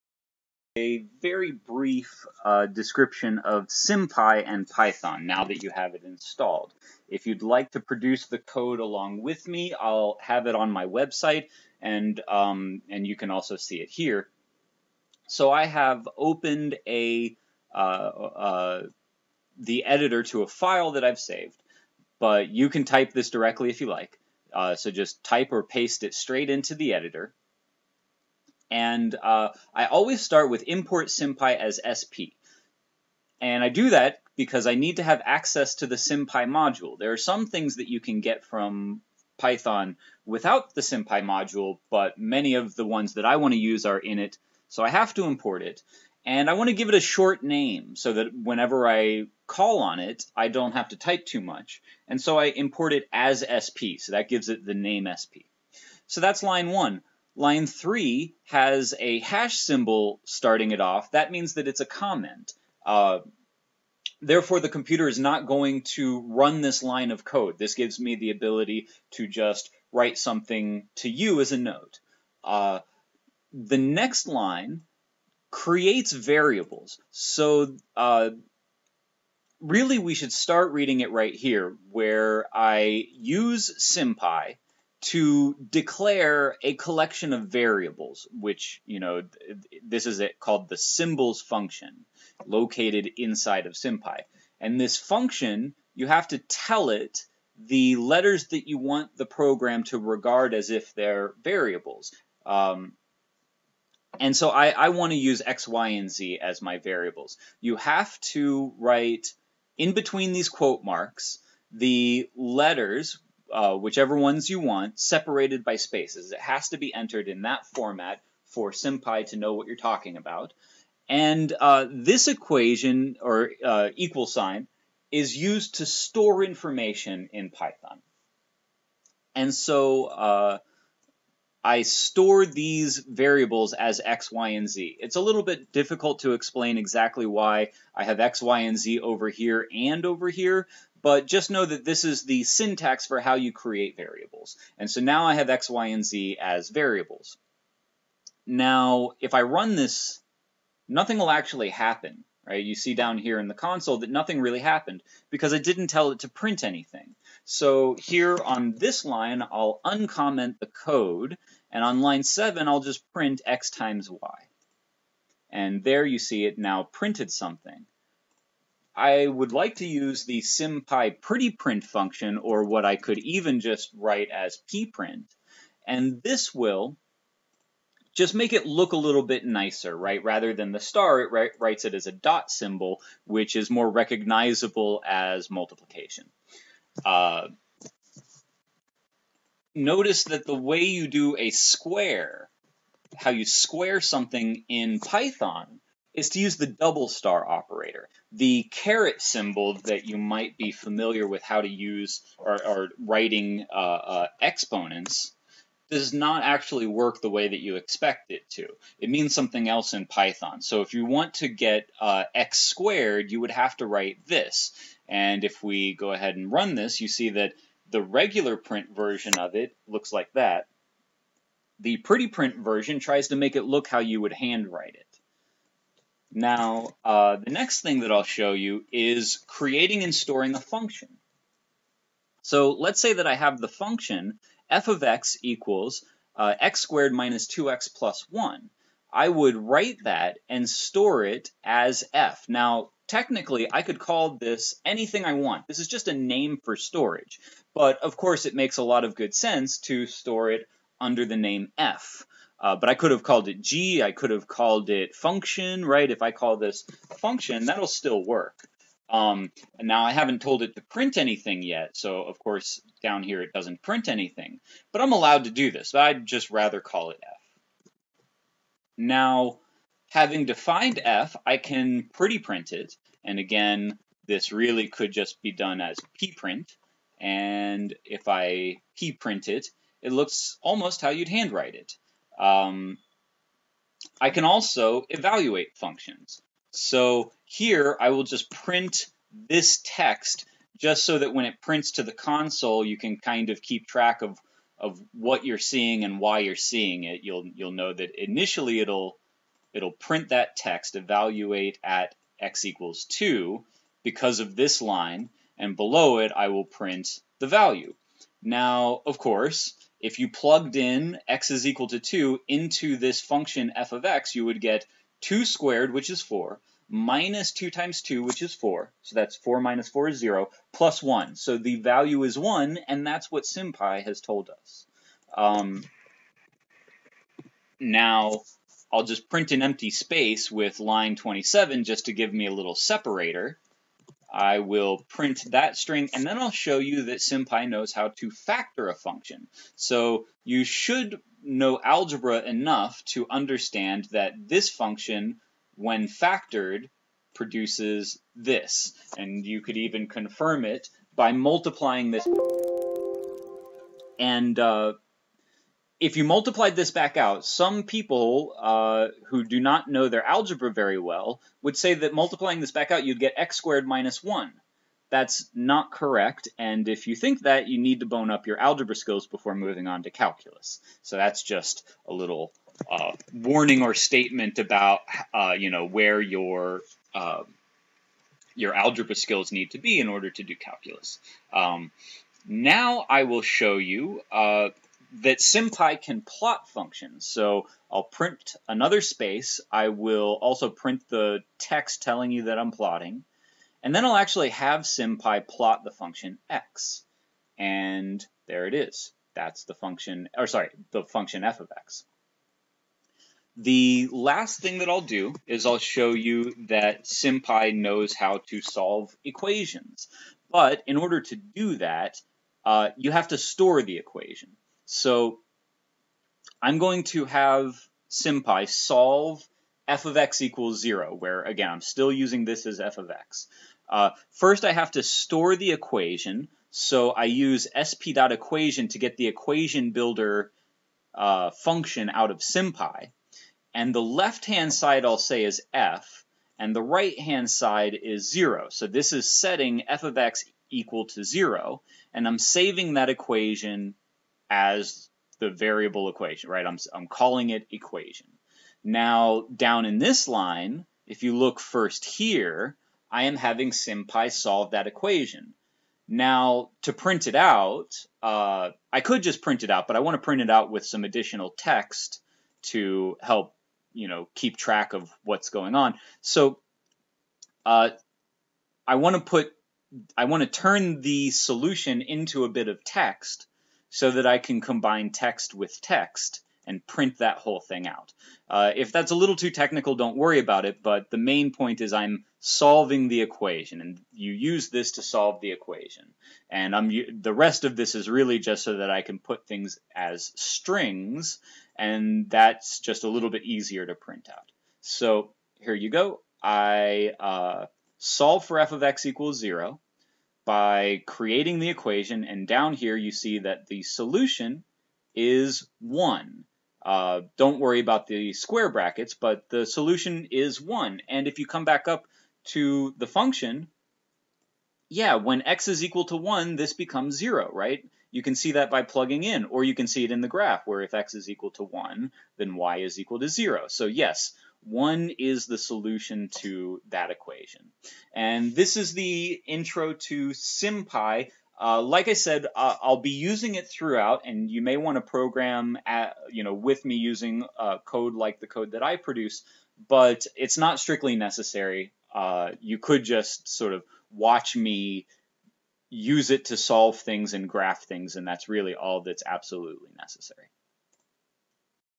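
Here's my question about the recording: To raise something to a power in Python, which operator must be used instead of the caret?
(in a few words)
double star operator.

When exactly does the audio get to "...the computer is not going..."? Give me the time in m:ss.
1:04.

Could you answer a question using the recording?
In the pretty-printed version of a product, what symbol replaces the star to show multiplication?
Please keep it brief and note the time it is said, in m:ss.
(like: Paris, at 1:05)
dot symbol, at 3:02.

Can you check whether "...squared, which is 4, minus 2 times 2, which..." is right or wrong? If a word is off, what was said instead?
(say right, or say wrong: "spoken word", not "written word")
right.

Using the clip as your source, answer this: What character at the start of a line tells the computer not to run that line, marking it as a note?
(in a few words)
hash symbol.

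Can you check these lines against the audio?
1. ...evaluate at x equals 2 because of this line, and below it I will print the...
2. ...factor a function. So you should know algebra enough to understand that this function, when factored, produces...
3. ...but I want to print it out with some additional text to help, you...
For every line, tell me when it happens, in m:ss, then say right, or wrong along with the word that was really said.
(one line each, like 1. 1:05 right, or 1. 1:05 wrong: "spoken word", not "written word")
1. 5:00 right
2. 5:38 right
3. 7:39 right.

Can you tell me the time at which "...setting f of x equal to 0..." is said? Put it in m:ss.
7:19.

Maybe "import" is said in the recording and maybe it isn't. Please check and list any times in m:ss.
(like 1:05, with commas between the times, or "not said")
0:30, 0:45, 0:52.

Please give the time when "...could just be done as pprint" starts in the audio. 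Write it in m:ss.
4:34.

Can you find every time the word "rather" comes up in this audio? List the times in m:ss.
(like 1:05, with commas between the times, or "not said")
3:00, 4:26.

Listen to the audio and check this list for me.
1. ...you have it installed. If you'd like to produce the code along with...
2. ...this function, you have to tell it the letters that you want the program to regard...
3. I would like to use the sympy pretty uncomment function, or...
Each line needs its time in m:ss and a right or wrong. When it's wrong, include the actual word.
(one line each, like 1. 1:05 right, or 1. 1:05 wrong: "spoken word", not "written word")
1. 0:05 right
2. 1:34 right
3. 2:48 wrong: "print", not "uncomment".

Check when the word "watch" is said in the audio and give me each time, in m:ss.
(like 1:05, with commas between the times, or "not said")
9:04.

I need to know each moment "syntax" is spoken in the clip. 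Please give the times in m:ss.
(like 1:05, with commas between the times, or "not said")
2:22.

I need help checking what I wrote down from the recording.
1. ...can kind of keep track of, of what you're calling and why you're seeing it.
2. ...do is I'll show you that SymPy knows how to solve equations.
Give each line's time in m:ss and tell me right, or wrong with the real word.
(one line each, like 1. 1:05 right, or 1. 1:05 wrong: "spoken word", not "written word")
1. 4:52 wrong: "seeing", not "calling"
2. 6:45 right.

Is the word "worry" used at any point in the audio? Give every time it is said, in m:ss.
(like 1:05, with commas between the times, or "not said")
8:00, 8:27.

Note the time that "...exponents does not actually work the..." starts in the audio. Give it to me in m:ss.
3:24.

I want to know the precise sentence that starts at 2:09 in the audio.
And so uh, I store these variables as X, Y, and Z.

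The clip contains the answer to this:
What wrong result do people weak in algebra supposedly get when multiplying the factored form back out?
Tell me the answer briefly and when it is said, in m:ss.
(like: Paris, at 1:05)
x squared minus 1, at 6:03.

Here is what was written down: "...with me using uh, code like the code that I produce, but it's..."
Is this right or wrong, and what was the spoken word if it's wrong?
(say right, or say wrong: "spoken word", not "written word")
right.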